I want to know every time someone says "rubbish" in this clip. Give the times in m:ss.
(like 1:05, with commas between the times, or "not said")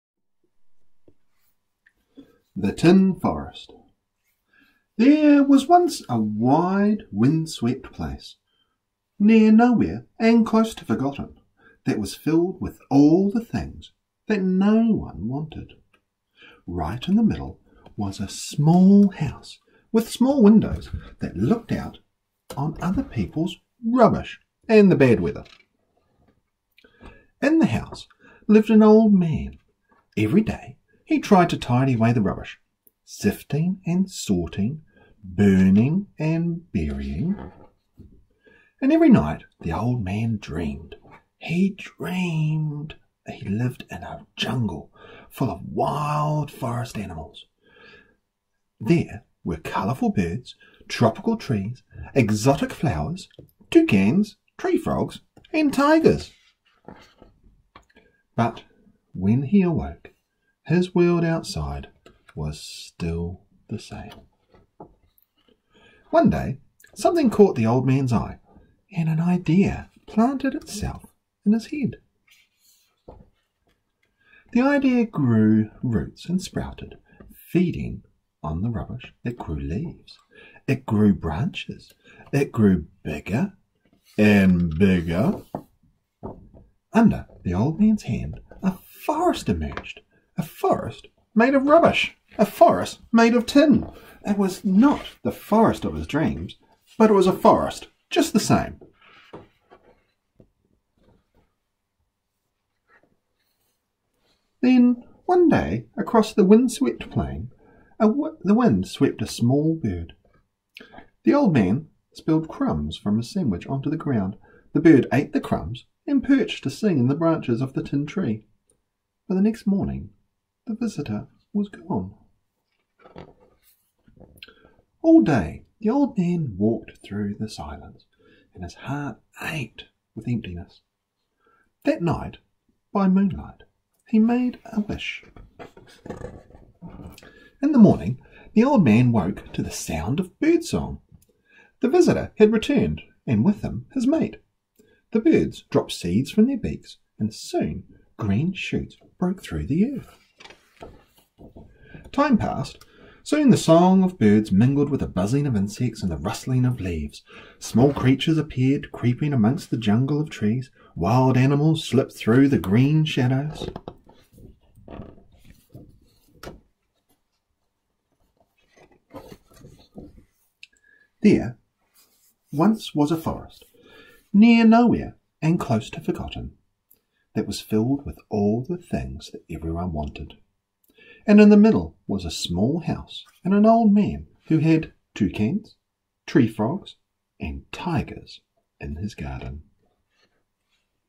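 0:23, 0:32, 1:18, 1:31.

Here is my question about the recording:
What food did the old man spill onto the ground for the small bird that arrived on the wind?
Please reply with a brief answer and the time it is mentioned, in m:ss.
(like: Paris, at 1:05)
Crumbs from a sandwich, at 1:52.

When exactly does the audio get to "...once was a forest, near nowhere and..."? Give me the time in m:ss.
2:52.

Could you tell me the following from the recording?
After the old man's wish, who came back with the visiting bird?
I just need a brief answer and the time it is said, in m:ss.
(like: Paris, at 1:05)
His mate, at 2:23.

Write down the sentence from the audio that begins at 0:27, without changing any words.
In the house lived an old man.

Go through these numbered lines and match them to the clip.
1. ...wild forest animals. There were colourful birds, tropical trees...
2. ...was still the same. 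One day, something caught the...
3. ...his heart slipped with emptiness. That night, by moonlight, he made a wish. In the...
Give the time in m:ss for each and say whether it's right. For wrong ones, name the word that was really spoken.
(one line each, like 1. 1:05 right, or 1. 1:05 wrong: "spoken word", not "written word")
1. 0:45 right
2. 1:02 right
3. 2:08 wrong: "ached", not "slipped".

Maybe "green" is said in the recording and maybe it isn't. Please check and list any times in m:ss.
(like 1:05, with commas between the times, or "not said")
2:28, 2:42.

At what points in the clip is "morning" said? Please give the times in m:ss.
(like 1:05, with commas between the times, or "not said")
1:59, 2:17.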